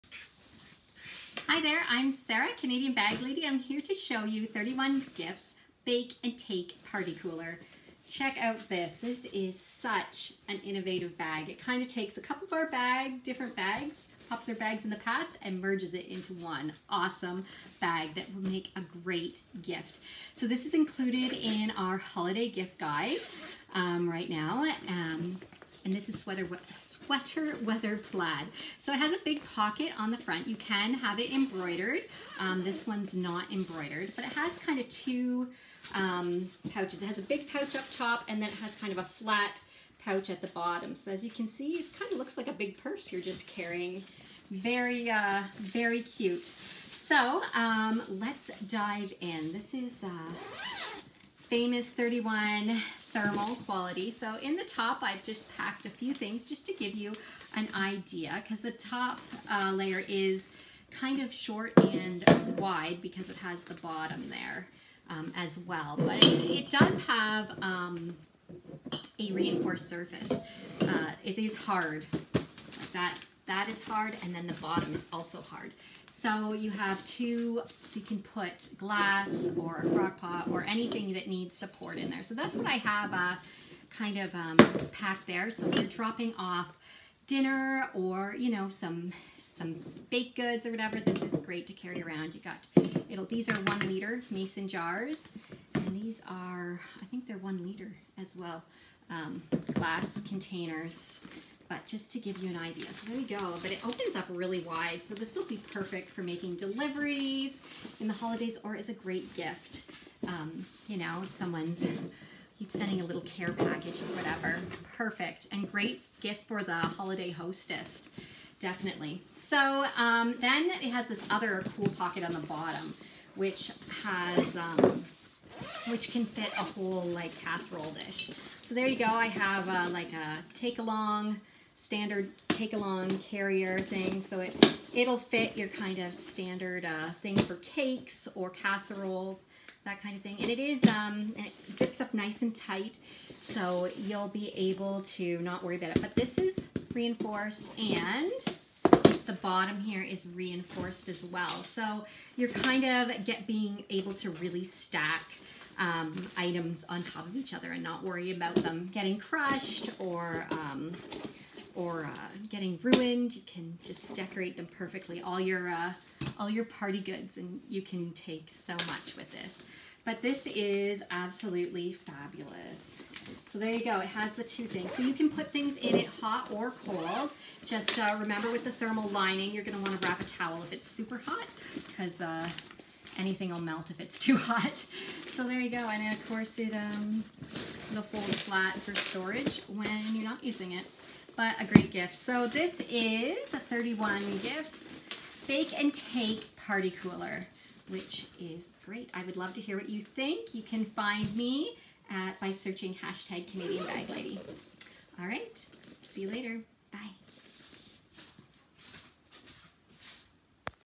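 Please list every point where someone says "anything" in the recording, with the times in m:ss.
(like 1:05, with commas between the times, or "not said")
1:20, 3:03.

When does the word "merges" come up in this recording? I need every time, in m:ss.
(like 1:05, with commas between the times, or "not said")
0:15.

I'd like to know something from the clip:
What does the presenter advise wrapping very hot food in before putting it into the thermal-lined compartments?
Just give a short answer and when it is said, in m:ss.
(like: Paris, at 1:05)
a towel, at 3:00.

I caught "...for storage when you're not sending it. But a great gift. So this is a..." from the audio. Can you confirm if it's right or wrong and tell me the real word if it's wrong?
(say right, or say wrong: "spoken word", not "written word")
wrong: "using", not "sending".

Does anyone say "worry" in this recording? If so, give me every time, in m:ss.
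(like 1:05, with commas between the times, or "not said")
2:25, 2:38.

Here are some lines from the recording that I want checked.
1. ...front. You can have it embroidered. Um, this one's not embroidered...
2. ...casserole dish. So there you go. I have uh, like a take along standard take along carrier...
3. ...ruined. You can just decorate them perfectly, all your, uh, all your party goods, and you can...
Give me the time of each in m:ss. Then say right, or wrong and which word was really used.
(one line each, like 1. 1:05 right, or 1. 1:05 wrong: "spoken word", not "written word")
1. 0:30 right
2. 2:07 right
3. 2:42 right.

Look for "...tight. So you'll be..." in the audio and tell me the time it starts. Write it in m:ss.
2:22.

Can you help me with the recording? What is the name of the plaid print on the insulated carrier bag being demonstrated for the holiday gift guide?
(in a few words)
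sweater weather plaid.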